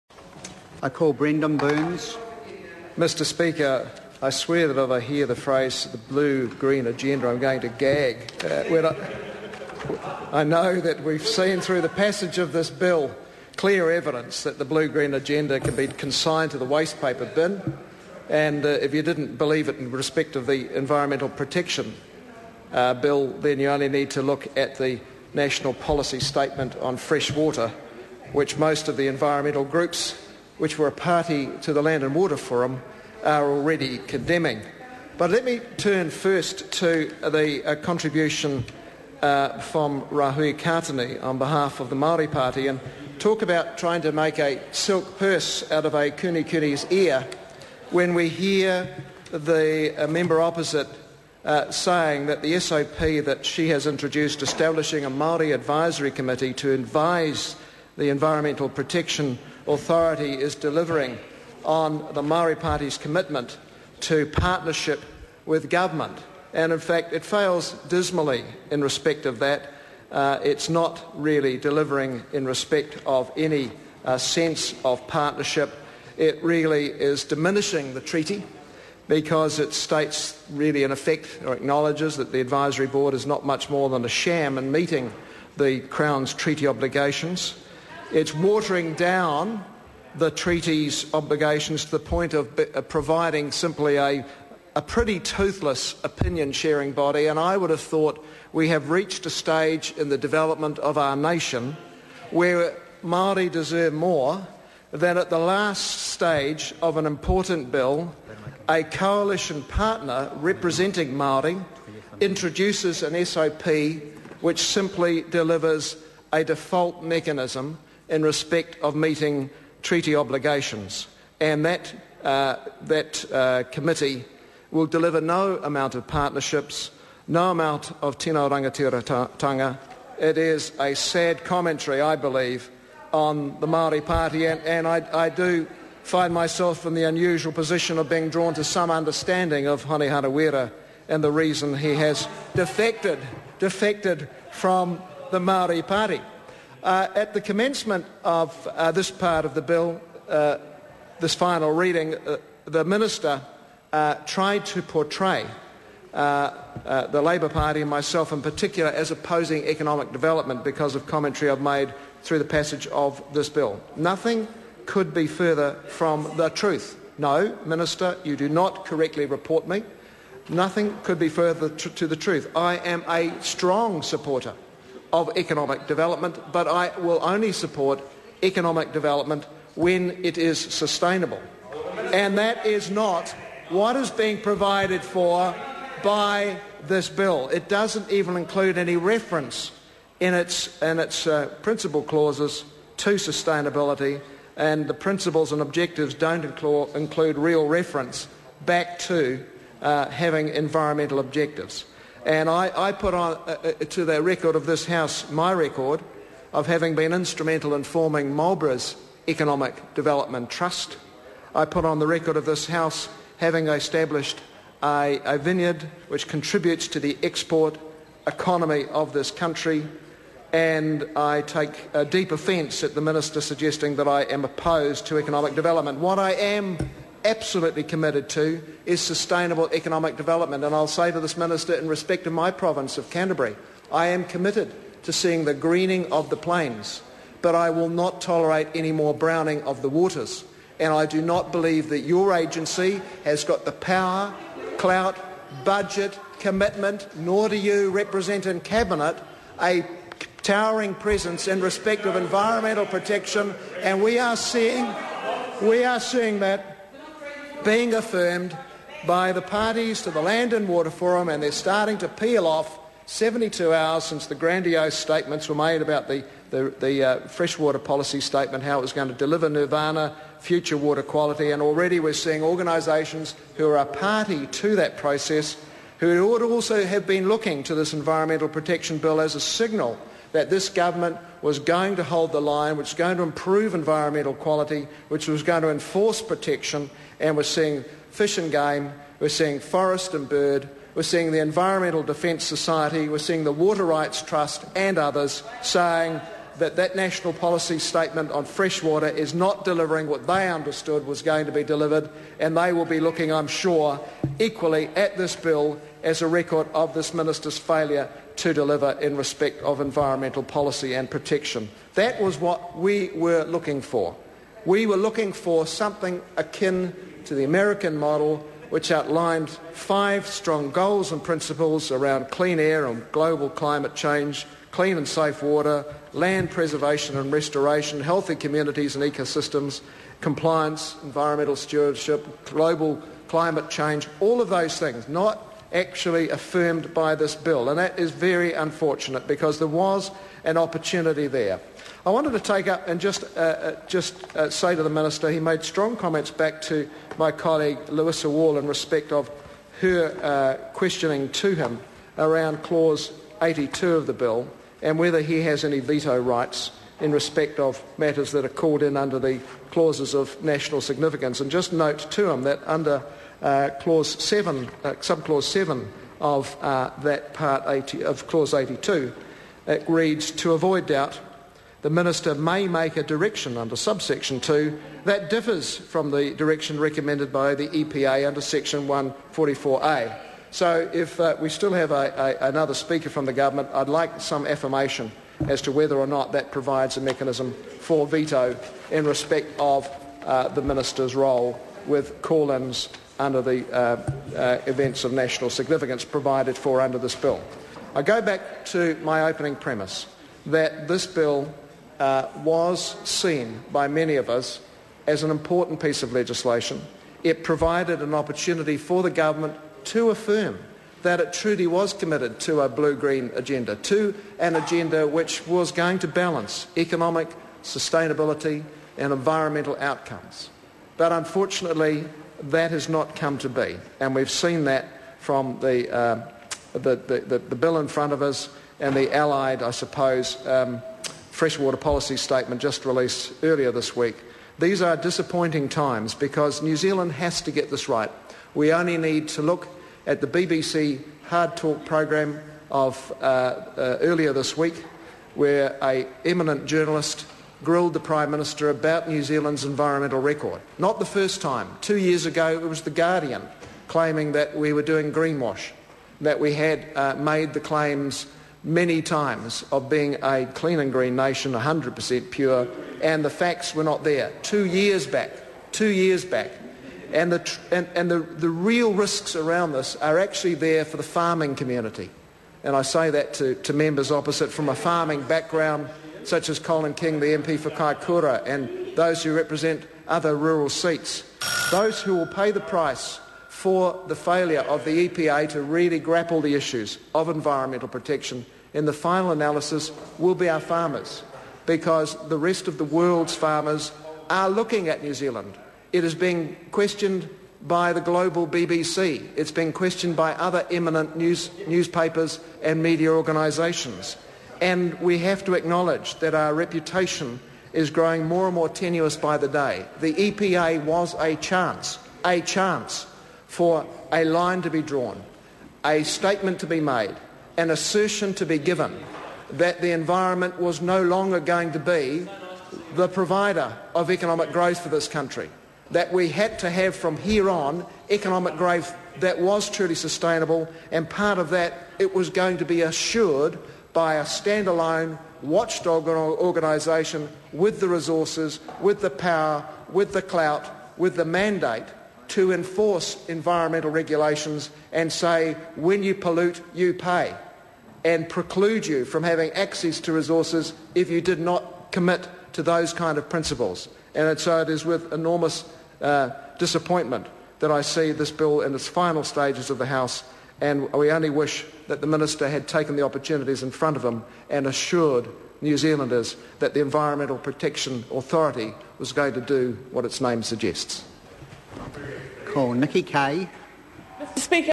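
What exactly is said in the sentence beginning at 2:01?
And that, uh, that uh, committee will deliver no amount of partnerships, no amount of tino rangatiratanga.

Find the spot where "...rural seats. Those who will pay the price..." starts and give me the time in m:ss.
8:00.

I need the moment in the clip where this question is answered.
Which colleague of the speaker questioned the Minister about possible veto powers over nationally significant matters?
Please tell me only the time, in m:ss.
5:47.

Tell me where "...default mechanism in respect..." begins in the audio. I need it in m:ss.
1:56.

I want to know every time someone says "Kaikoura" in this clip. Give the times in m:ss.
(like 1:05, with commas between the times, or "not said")
7:57.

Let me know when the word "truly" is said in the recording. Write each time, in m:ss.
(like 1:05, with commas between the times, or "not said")
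6:51, 8:49.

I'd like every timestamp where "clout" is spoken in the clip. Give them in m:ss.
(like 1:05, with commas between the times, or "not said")
4:04, 9:00.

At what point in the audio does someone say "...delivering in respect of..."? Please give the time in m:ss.
1:11.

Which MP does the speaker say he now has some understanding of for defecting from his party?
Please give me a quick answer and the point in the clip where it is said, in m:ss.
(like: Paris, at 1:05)
Hone Harawira, at 2:19.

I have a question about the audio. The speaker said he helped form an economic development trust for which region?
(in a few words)
Marlborough.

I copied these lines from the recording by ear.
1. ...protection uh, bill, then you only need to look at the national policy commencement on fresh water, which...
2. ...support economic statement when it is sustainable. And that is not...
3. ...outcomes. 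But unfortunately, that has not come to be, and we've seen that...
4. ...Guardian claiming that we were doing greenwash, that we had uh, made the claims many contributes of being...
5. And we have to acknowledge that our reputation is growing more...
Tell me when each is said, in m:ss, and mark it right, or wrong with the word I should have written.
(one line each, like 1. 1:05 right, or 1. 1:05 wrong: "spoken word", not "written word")
1. 0:21 wrong: "statement", not "commencement"
2. 2:57 wrong: "development", not "statement"
3. 6:59 right
4. 7:32 wrong: "times", not "contributes"
5. 8:24 right.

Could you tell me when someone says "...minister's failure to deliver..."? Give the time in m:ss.
5:07.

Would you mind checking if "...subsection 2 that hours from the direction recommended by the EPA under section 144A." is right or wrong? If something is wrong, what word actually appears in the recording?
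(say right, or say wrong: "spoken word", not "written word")
wrong: "differs", not "hours".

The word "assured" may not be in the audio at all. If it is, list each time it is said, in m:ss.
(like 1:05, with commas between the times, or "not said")
8:52, 9:24.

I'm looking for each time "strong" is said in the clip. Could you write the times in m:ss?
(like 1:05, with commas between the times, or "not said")
2:53, 5:20, 5:45.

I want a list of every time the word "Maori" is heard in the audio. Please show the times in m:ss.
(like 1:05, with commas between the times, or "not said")
0:41, 0:55, 1:02, 1:43, 1:51.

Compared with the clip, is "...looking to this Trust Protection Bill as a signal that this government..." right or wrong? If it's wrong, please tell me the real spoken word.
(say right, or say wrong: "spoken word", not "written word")
wrong: "Environmental", not "Trust".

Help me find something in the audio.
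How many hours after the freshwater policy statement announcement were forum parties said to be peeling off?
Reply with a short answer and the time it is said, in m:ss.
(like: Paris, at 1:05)
72, at 4:23.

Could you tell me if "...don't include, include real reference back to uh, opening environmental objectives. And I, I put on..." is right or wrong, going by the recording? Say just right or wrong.
wrong.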